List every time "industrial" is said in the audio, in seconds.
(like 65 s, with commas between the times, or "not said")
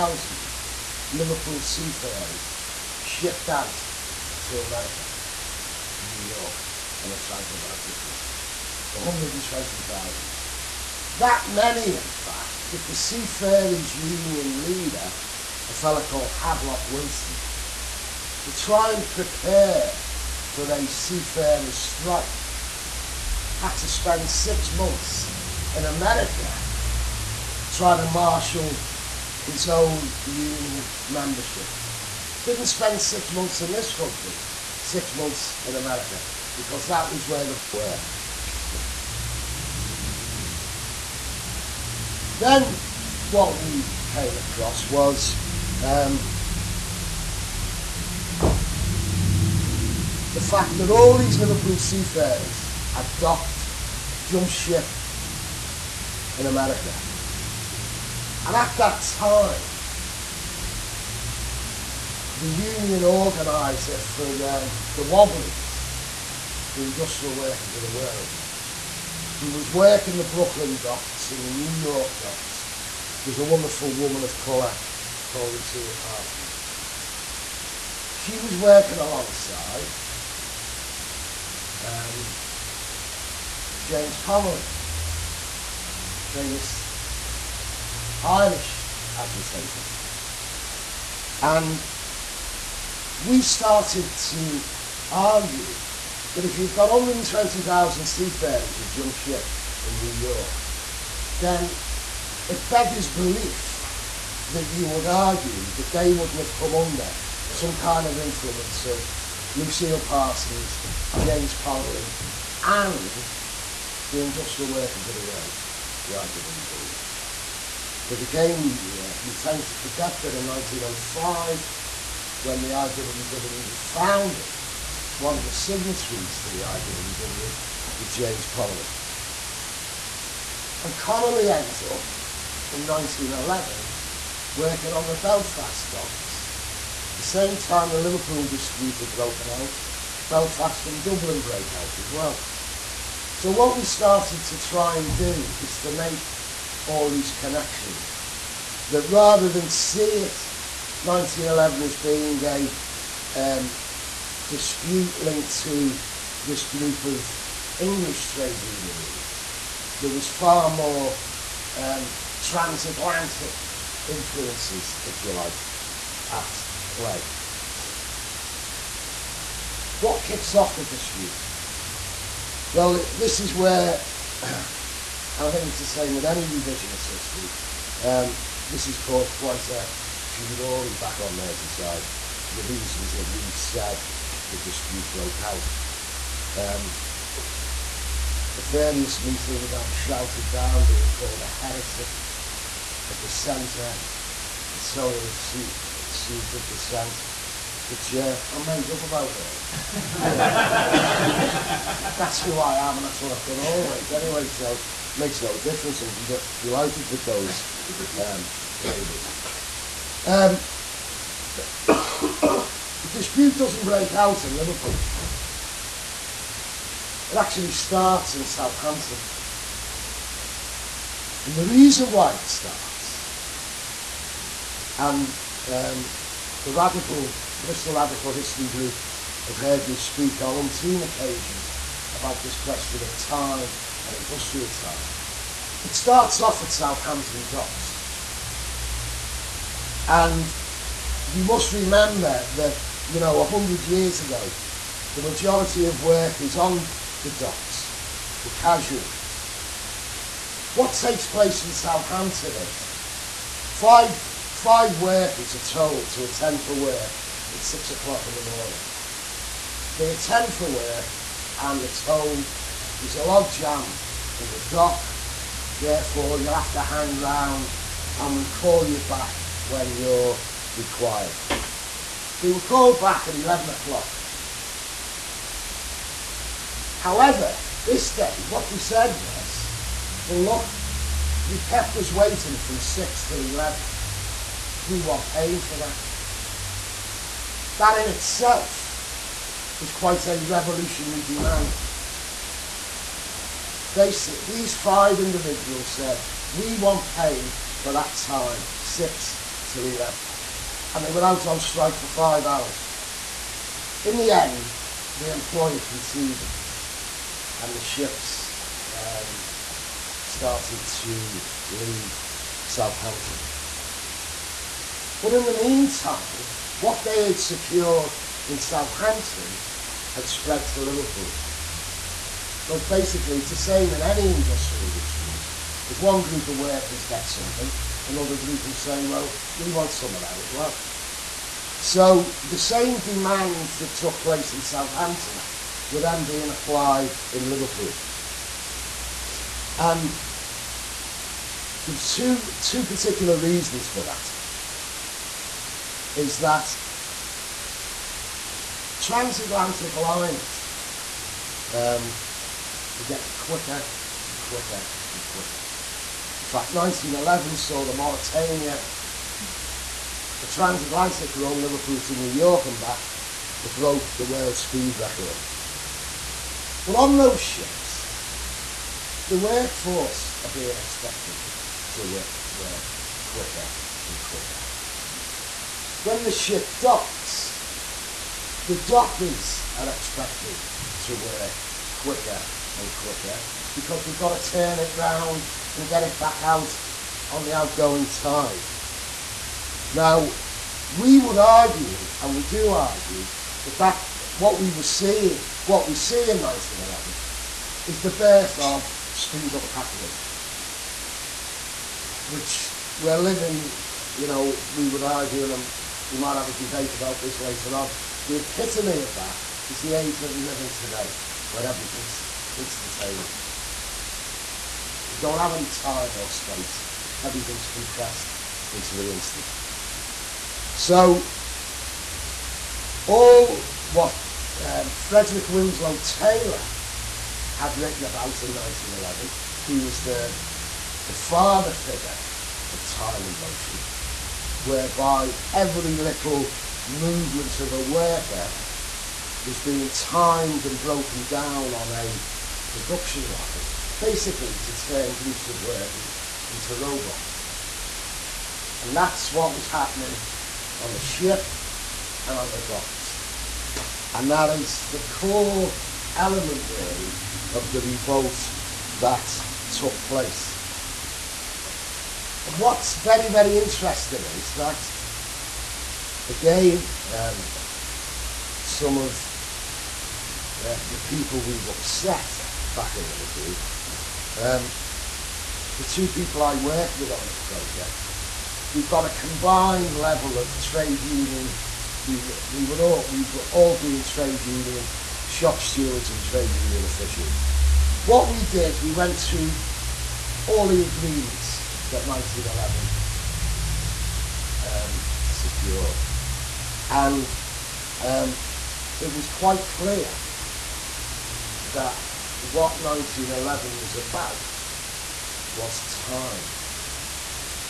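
66 s, 114 s, 234 s, 324 s.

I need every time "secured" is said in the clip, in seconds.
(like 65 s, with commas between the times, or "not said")
317 s, 495 s.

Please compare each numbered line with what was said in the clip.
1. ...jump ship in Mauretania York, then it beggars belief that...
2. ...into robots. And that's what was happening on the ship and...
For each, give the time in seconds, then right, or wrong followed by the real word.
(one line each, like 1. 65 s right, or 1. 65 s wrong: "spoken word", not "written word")
1. 98 s wrong: "New", not "Mauretania"
2. 446 s right.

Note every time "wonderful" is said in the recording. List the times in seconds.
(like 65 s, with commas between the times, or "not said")
73 s.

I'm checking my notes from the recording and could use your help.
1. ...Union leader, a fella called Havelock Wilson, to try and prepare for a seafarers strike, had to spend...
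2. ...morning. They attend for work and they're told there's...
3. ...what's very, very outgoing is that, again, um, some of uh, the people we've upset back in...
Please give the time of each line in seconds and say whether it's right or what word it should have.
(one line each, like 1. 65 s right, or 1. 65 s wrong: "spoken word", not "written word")
1. 13 s right
2. 258 s right
3. 462 s wrong: "interesting", not "outgoing".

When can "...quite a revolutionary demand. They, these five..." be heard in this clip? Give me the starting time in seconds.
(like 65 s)
289 s.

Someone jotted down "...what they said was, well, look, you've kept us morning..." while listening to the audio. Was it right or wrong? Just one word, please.
wrong.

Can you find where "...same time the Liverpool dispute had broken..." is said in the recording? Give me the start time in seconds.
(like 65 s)
137 s.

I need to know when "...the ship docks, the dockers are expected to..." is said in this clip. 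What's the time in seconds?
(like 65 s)
376 s.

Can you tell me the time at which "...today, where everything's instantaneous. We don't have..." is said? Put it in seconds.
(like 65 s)
410 s.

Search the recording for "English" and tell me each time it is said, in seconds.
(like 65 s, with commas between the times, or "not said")
157 s.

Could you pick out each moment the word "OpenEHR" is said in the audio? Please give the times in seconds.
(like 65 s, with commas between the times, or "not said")
not said.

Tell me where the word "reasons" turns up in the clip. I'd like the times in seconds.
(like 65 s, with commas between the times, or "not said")
182 s, 221 s, 343 s.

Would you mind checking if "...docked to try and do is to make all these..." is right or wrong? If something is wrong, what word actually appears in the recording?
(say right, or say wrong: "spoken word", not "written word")
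wrong: "started", not "docked".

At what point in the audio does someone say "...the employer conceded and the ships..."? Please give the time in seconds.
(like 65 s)
305 s.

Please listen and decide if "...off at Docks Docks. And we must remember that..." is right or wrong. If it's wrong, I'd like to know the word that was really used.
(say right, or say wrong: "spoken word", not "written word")
wrong: "Southampton", not "Docks".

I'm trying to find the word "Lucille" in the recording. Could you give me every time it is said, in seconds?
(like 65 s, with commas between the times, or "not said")
75 s, 109 s.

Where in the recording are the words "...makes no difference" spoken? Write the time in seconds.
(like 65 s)
205 s.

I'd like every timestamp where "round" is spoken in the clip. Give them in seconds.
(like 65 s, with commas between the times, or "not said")
267 s, 384 s.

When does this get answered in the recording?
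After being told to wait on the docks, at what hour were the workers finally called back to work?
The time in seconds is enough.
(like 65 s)
273 s.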